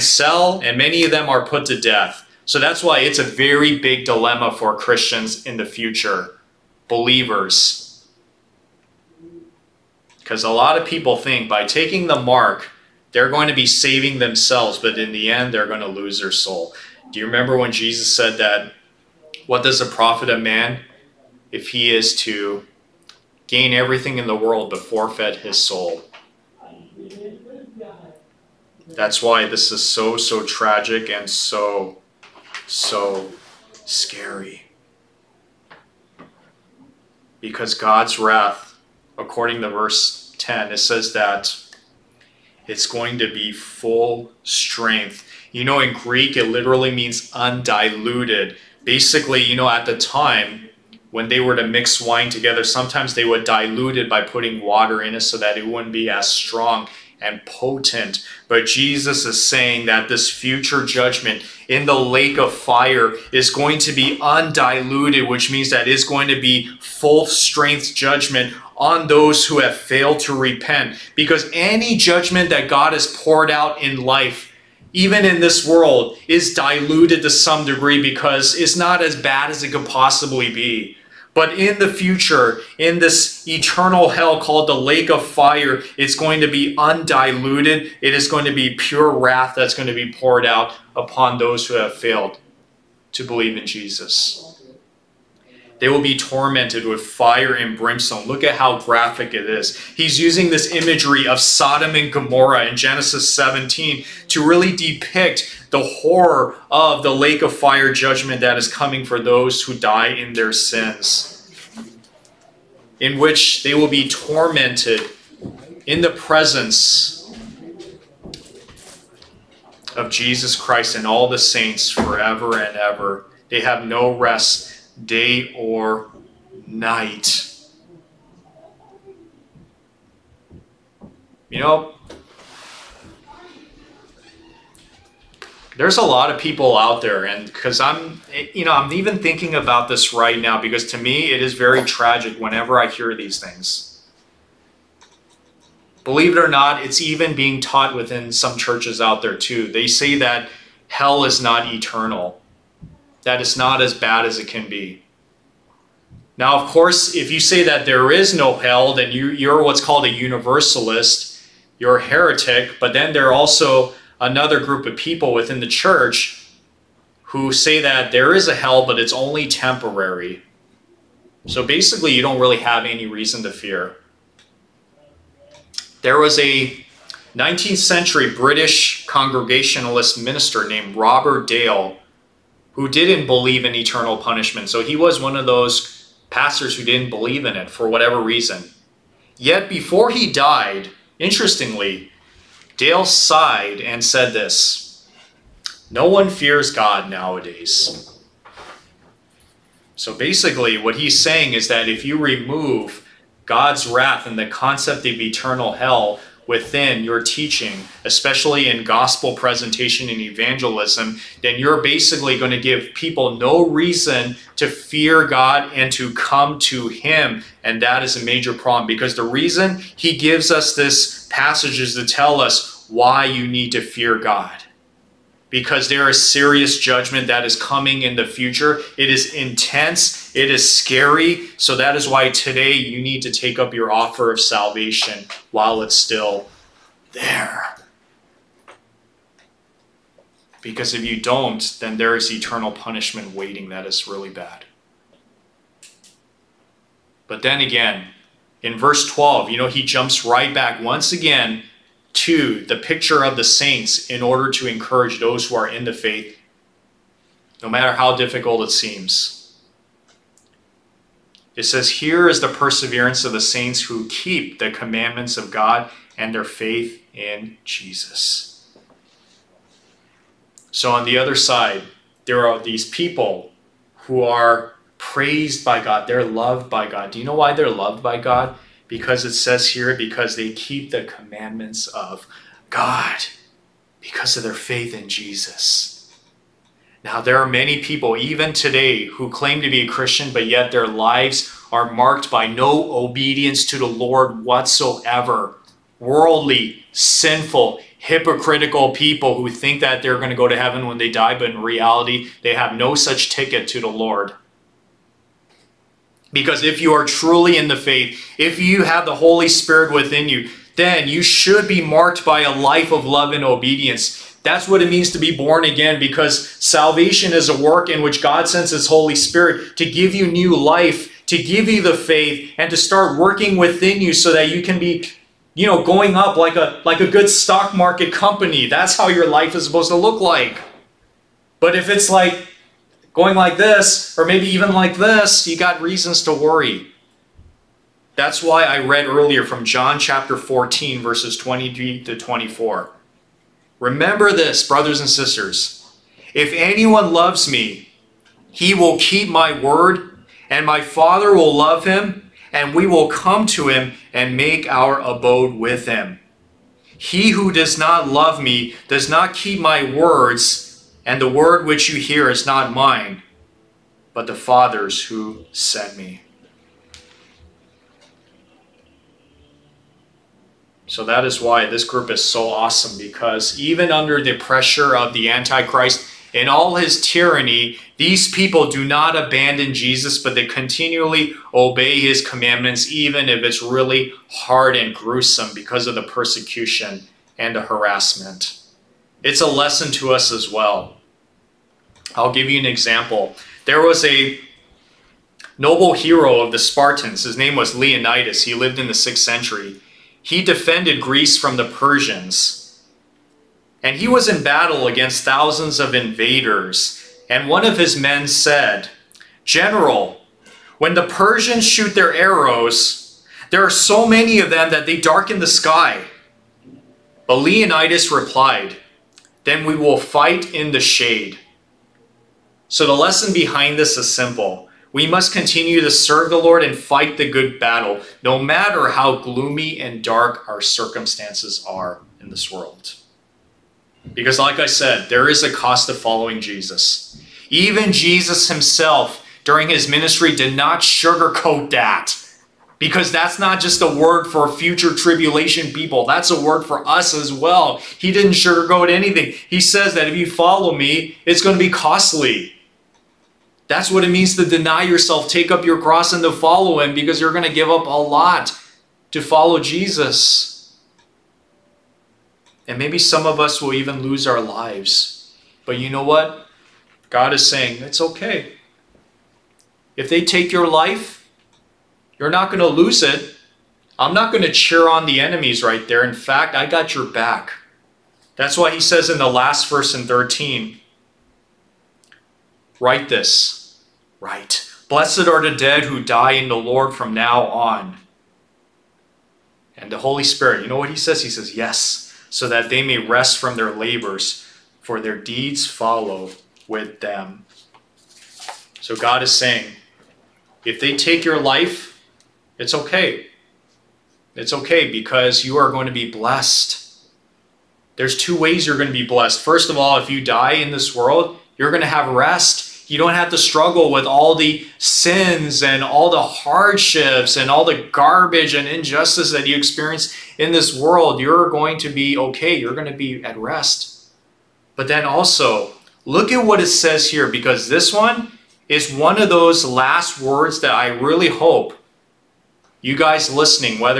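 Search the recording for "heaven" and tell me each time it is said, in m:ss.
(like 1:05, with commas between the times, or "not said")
5:00.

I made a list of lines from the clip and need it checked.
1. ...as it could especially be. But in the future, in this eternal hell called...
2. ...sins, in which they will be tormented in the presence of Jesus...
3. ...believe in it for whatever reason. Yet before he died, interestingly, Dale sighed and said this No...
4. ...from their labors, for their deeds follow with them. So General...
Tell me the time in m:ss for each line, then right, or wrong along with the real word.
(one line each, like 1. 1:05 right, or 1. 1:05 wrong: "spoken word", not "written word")
1. 1:19 wrong: "possibly", not "especially"
2. 1:50 right
3. 3:07 right
4. 8:13 wrong: "God", not "General".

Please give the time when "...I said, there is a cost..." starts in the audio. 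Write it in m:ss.
7:14.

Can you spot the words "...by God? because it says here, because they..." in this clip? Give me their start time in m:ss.
4:38.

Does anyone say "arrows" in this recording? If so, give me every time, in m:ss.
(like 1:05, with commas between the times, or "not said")
6:52.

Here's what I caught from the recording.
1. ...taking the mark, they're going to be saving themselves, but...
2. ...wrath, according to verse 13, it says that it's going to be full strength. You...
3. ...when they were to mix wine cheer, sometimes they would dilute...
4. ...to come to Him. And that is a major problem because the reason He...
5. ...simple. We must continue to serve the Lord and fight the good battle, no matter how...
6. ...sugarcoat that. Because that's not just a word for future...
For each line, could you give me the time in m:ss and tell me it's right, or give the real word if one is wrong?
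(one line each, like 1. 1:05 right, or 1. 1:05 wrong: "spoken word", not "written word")
1. 0:11 right
2. 0:38 wrong: "10", not "13"
3. 0:51 wrong: "together", not "cheer"
4. 3:35 right
5. 7:04 right
6. 7:20 right.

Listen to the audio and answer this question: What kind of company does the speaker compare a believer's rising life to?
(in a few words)
a good stock market company.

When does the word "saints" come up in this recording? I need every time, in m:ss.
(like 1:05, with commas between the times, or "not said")
2:01, 4:13, 4:23.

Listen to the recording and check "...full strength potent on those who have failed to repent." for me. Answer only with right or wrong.
wrong.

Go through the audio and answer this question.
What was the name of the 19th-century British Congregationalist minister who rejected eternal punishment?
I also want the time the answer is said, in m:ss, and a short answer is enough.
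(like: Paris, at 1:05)
Robert Dale, at 3:00.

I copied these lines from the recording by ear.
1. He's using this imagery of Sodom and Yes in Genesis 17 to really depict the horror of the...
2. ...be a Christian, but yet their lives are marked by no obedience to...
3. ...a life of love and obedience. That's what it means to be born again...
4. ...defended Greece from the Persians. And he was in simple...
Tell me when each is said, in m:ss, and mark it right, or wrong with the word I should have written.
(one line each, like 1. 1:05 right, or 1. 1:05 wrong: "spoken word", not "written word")
1. 1:39 wrong: "Gomorrah", not "Yes"
2. 4:49 right
3. 5:12 right
4. 6:40 wrong: "battle", not "simple".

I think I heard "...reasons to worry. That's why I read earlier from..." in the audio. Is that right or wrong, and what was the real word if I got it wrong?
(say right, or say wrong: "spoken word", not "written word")
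right.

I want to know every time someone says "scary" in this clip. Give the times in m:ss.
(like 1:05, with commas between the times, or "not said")
0:33, 3:50.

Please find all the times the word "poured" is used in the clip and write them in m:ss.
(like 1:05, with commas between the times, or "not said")
1:13, 1:30.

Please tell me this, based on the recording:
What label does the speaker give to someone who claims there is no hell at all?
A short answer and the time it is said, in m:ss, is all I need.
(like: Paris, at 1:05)
universalist, at 2:40.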